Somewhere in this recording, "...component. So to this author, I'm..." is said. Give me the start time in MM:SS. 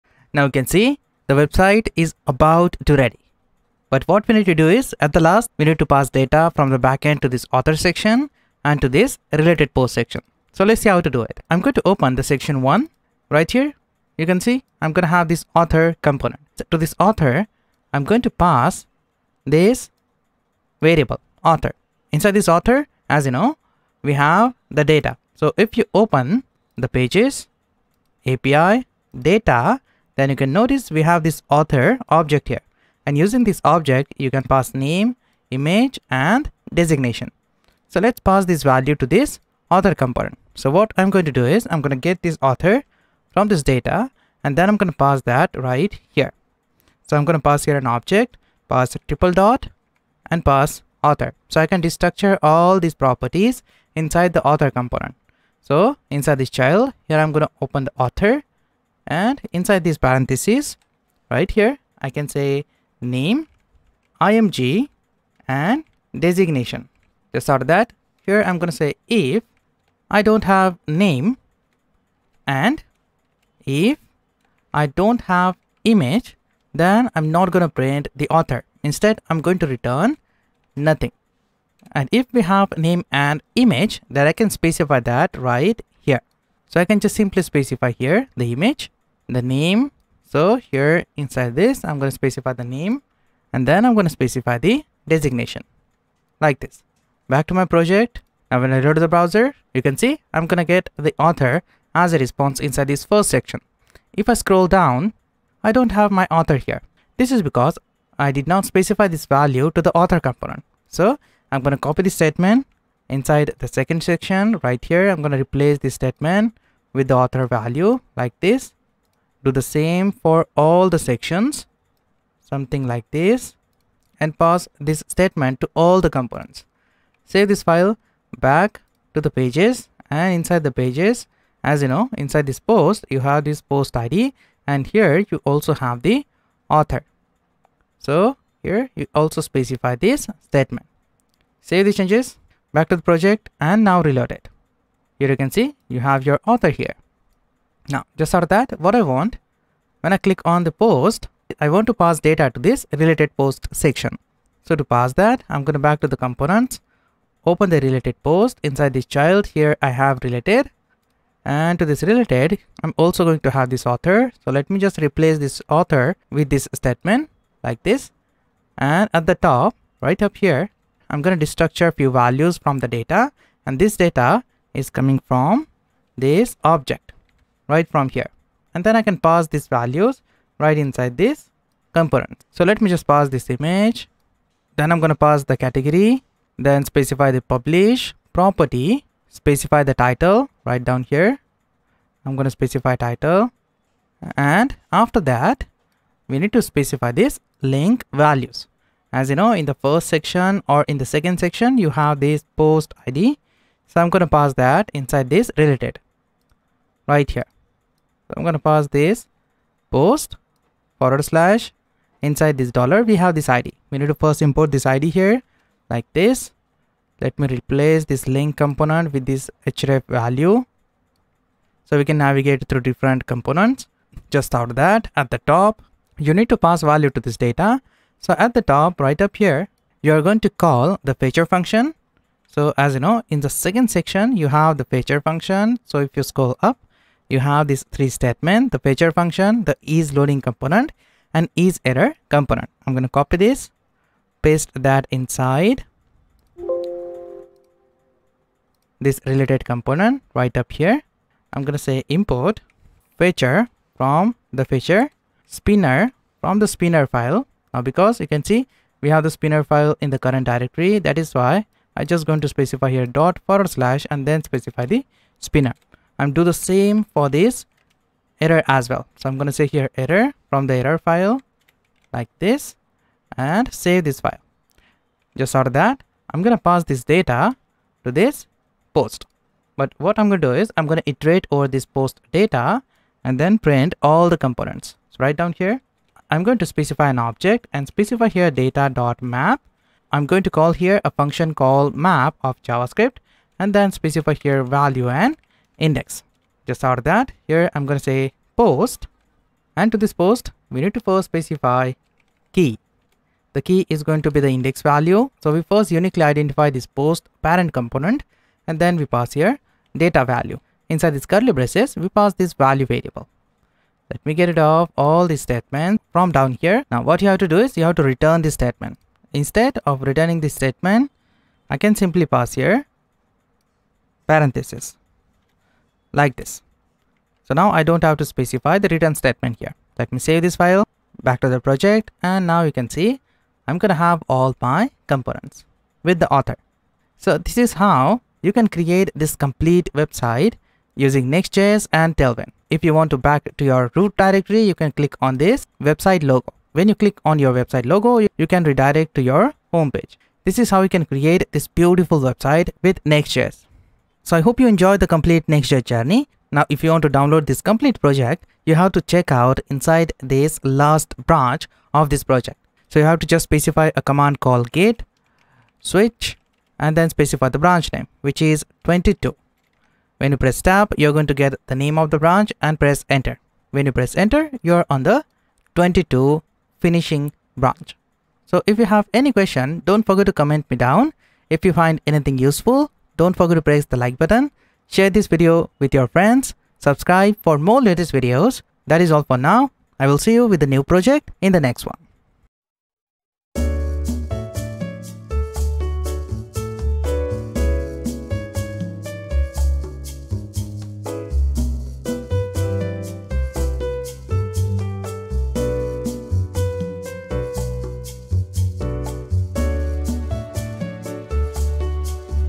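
00:16.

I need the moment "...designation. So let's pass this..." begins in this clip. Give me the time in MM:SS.
00:36.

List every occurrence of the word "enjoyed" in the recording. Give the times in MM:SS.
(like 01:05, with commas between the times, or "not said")
05:54.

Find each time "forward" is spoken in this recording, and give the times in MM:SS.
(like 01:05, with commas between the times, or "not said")
03:30, 04:23.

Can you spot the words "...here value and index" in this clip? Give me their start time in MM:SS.
04:54.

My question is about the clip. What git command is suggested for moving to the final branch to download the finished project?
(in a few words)
git switch.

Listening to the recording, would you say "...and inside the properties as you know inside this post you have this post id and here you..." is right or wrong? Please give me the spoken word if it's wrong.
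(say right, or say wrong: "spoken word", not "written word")
wrong: "pages", not "properties".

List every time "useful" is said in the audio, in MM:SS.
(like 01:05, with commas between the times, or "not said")
06:22.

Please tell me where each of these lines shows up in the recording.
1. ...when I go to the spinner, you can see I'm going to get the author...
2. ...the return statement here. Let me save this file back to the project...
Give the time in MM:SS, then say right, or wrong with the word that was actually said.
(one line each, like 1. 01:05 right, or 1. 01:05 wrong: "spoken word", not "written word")
1. 01:38 wrong: "browser", not "spinner"
2. 05:28 right.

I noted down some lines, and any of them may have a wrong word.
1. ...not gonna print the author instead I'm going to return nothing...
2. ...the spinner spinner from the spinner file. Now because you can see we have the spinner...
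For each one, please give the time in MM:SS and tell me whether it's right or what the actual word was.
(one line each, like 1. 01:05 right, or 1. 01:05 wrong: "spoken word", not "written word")
1. 01:17 right
2. 04:14 wrong: "fetcher", not "spinner".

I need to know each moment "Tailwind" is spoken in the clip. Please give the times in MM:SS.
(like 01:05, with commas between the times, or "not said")
05:42.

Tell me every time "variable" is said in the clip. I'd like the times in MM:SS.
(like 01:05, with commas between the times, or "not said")
00:20, 05:12.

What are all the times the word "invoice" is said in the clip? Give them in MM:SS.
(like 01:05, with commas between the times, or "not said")
not said.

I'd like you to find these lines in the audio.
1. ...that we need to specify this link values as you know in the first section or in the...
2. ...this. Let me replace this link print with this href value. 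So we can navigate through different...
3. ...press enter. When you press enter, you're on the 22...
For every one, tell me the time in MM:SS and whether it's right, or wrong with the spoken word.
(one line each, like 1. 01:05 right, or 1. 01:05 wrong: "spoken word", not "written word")
1. 03:15 right
2. 03:36 wrong: "component", not "print"
3. 06:12 right.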